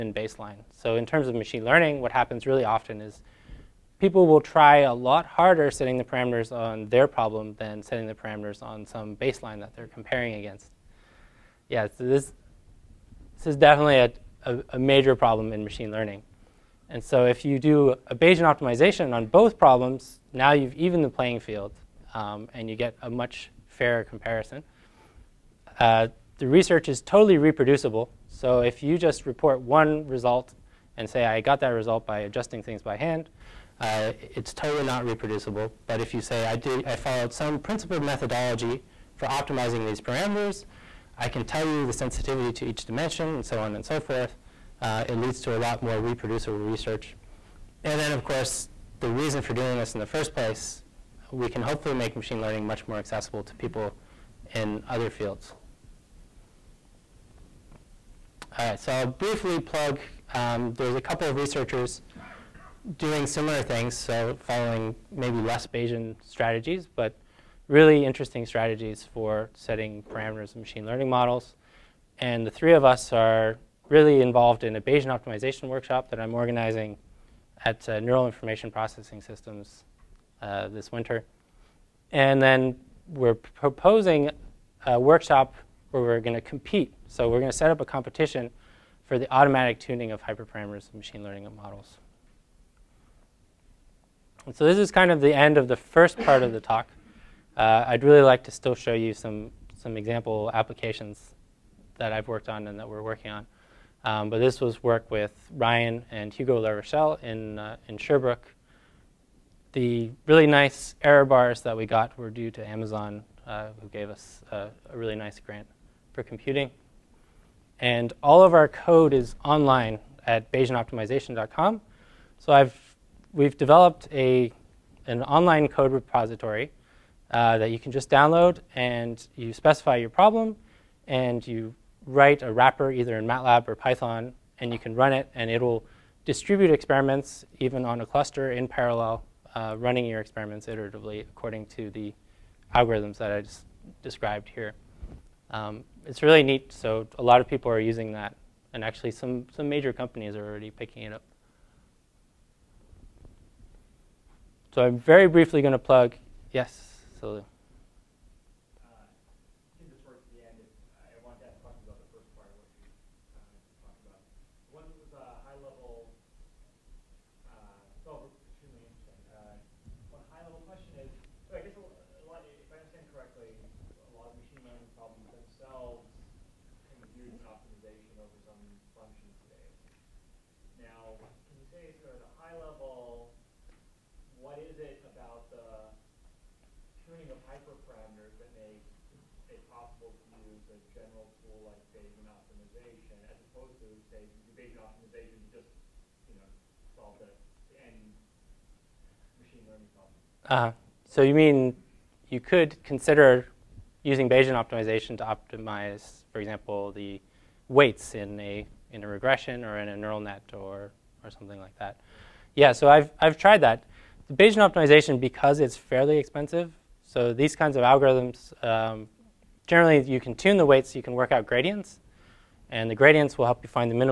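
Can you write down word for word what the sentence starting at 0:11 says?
Yeah, so this, this is definitely a, a, a major problem in machine learning.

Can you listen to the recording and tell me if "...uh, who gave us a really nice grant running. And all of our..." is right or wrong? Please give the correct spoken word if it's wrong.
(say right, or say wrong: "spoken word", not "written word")
wrong: "computing", not "running".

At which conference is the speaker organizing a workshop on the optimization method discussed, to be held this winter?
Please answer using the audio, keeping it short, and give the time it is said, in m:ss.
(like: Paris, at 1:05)
Neural Information Processing Systems, at 1:17.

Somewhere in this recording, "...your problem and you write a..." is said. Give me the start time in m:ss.
2:09.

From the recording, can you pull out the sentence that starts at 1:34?
And so this is kind of the end of the first part of the talk.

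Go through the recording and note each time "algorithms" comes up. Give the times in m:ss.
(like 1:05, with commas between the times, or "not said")
2:22, 3:37.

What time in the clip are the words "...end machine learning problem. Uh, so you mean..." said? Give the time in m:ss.
3:17.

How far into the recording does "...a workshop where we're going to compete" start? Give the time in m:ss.
1:24.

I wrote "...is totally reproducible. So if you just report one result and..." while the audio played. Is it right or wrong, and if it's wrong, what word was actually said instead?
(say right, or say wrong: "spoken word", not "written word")
right.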